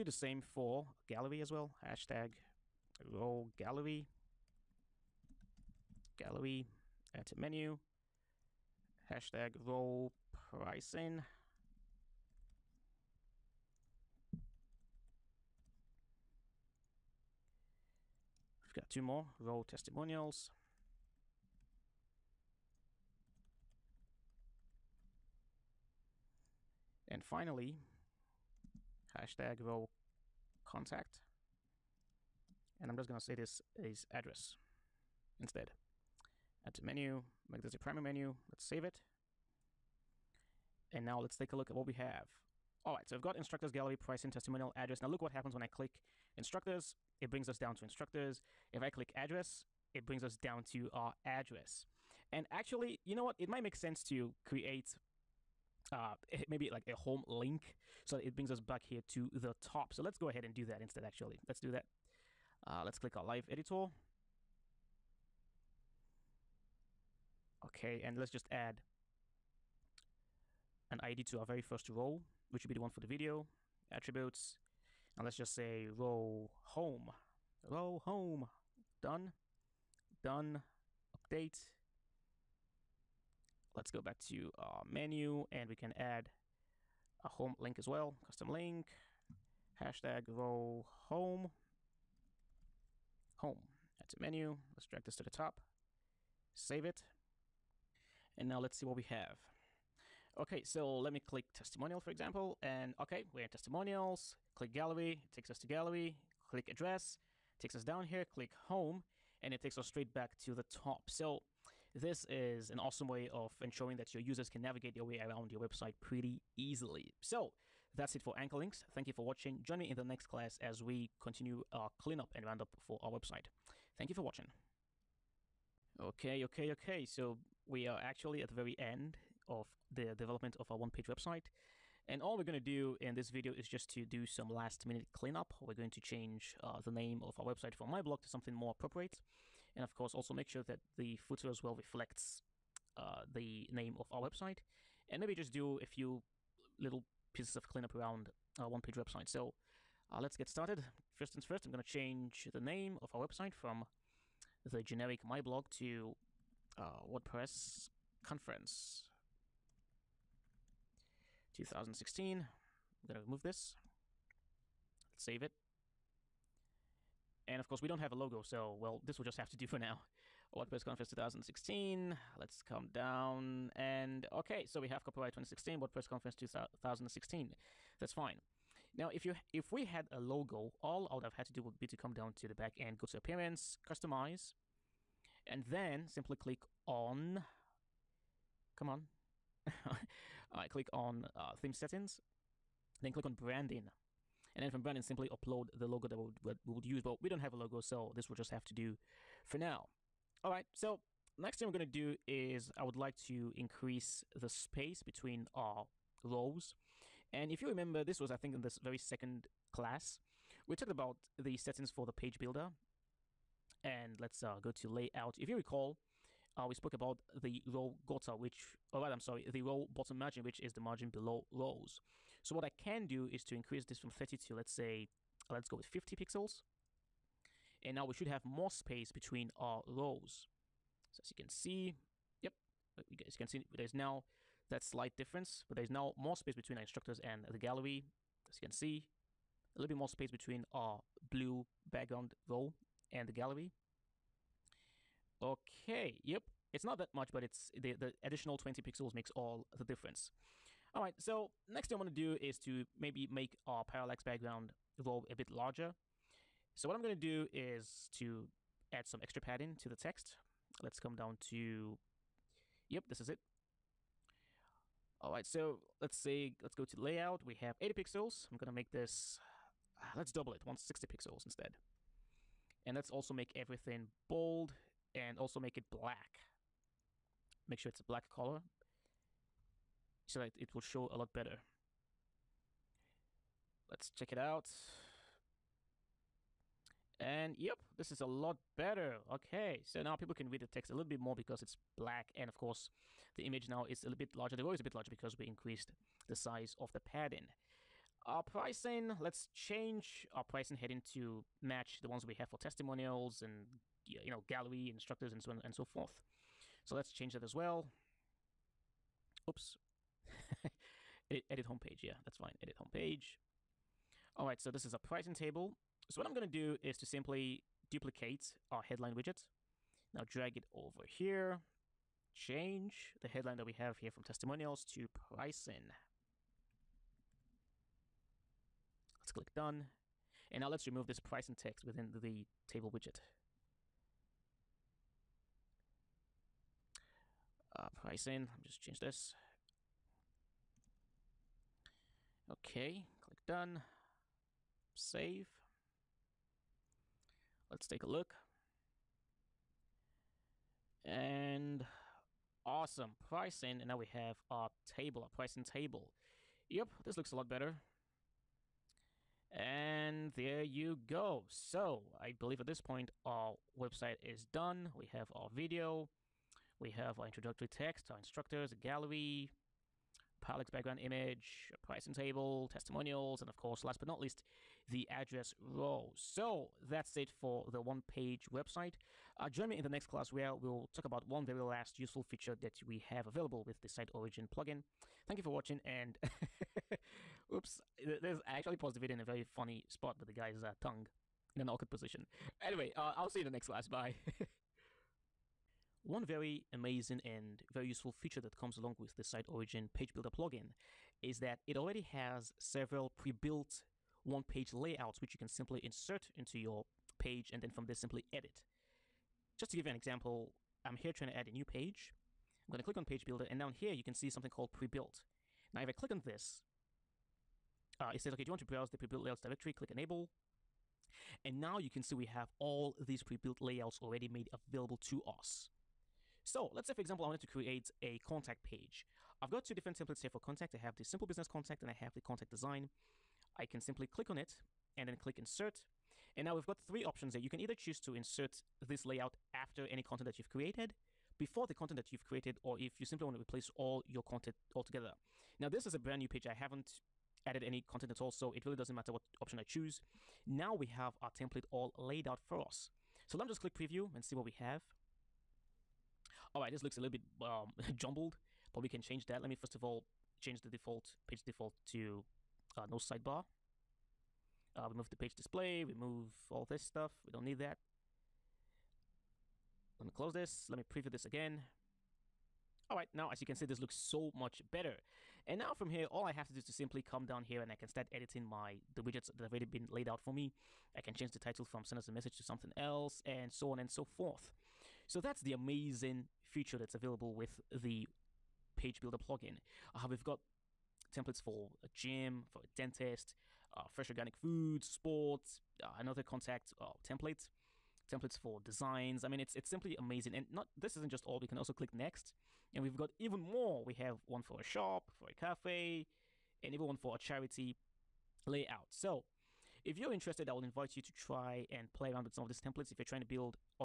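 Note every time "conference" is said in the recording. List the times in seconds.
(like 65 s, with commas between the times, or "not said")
158 s, 170 s, 176 s.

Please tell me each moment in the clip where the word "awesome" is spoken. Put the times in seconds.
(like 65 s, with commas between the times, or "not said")
112 s, 352 s.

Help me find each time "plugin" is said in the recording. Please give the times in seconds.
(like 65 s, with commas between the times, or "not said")
384 s, 400 s, 489 s.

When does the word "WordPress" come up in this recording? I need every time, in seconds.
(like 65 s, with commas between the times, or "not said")
157 s, 170 s, 175 s.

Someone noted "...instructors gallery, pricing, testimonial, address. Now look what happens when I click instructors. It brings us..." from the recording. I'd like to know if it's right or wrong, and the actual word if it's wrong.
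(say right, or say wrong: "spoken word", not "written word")
right.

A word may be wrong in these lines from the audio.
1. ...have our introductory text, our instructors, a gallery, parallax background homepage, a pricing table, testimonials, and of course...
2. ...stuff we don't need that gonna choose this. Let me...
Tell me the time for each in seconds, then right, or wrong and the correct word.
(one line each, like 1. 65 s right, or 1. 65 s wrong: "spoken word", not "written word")
1. 366 s wrong: "image", not "homepage"
2. 466 s wrong: "close", not "choose".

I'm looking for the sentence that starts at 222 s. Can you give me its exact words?
So what I can do is to increase this from 30 to, let's say, let's go with 50 pixels.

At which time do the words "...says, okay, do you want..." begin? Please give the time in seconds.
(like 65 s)
418 s.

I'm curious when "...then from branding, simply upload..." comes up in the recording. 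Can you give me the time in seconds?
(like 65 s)
194 s.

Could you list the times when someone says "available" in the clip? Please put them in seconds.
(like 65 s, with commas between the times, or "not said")
383 s, 424 s, 486 s.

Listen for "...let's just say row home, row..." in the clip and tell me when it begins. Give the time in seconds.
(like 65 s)
75 s.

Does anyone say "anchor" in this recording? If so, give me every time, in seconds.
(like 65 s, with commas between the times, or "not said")
118 s.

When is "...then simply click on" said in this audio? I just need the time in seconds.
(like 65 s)
185 s.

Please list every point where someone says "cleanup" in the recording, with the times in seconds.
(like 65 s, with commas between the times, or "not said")
122 s, 135 s, 147 s.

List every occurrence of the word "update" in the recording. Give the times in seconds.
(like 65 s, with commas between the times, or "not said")
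81 s.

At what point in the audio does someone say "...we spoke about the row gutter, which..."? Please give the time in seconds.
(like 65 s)
216 s.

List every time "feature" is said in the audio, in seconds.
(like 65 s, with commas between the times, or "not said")
382 s, 398 s, 486 s.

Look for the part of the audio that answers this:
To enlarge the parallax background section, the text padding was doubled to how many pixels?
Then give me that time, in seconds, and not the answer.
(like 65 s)
270 s.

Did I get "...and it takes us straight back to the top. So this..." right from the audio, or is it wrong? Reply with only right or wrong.
right.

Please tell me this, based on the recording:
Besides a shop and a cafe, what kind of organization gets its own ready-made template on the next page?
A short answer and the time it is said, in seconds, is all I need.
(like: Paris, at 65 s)
charity, at 507 s.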